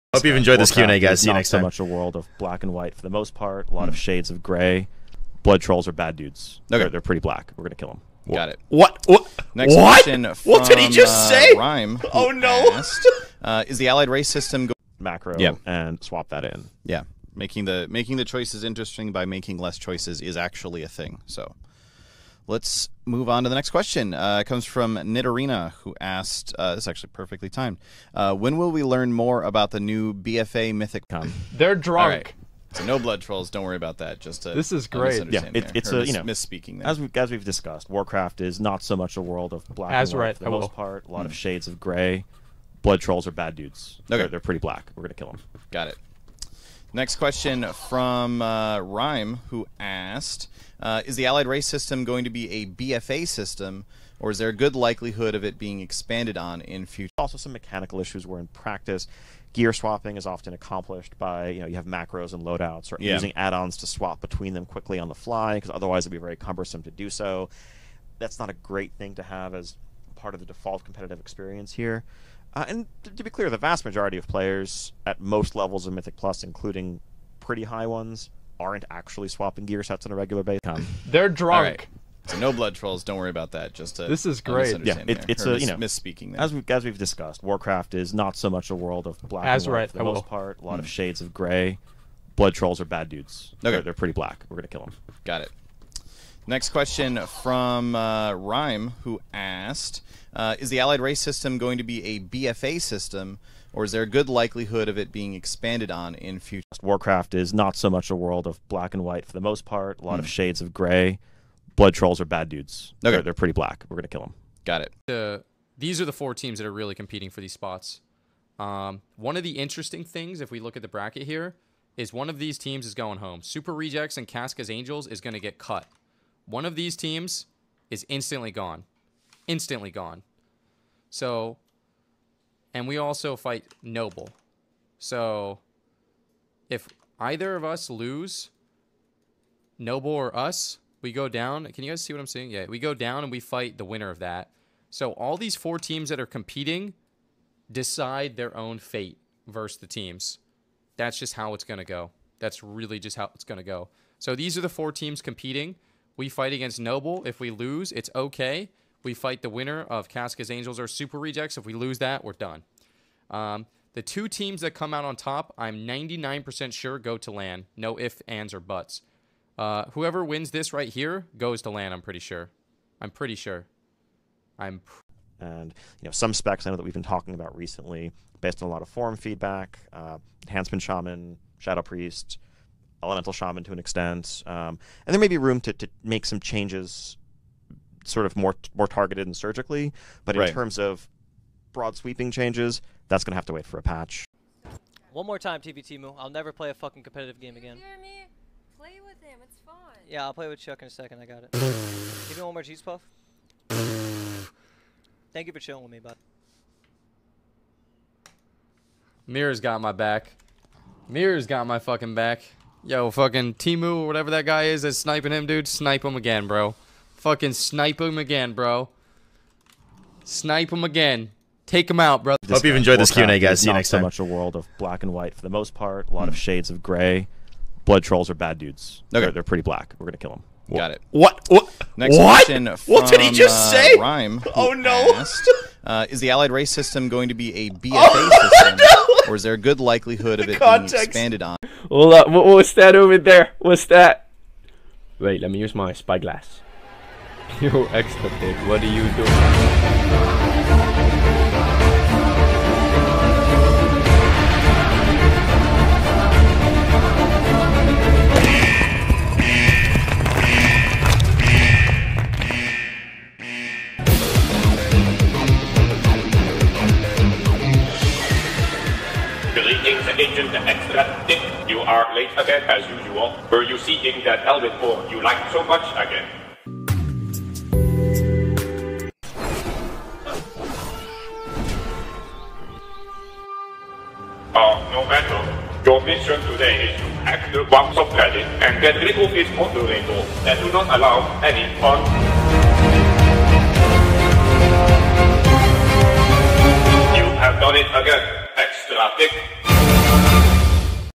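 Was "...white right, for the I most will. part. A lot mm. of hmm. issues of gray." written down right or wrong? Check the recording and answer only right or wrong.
wrong.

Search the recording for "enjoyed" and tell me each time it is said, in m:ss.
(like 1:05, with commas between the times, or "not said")
0:00, 3:42.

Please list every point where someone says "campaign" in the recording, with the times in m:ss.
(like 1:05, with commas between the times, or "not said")
not said.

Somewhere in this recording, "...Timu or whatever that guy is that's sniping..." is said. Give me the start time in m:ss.
3:33.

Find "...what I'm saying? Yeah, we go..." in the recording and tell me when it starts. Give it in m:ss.
2:22.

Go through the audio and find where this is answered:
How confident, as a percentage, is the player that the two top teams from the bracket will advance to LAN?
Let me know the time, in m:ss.
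2:45.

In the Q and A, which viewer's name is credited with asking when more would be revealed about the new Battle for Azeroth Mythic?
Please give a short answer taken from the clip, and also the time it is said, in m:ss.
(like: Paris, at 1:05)
Nitarina, at 0:24.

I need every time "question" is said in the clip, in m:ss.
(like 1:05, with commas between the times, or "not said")
0:23, 0:47, 1:36.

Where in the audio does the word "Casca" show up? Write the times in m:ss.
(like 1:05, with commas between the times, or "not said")
2:04, 2:40.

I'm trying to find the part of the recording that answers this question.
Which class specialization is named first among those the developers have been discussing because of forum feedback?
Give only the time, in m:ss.
3:00.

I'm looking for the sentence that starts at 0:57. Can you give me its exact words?
Also, some mechanical issues where in practice, gear swapping is often accomplished by you know you have macros and loadouts or yeah.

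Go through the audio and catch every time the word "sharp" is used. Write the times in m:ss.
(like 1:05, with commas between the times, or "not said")
not said.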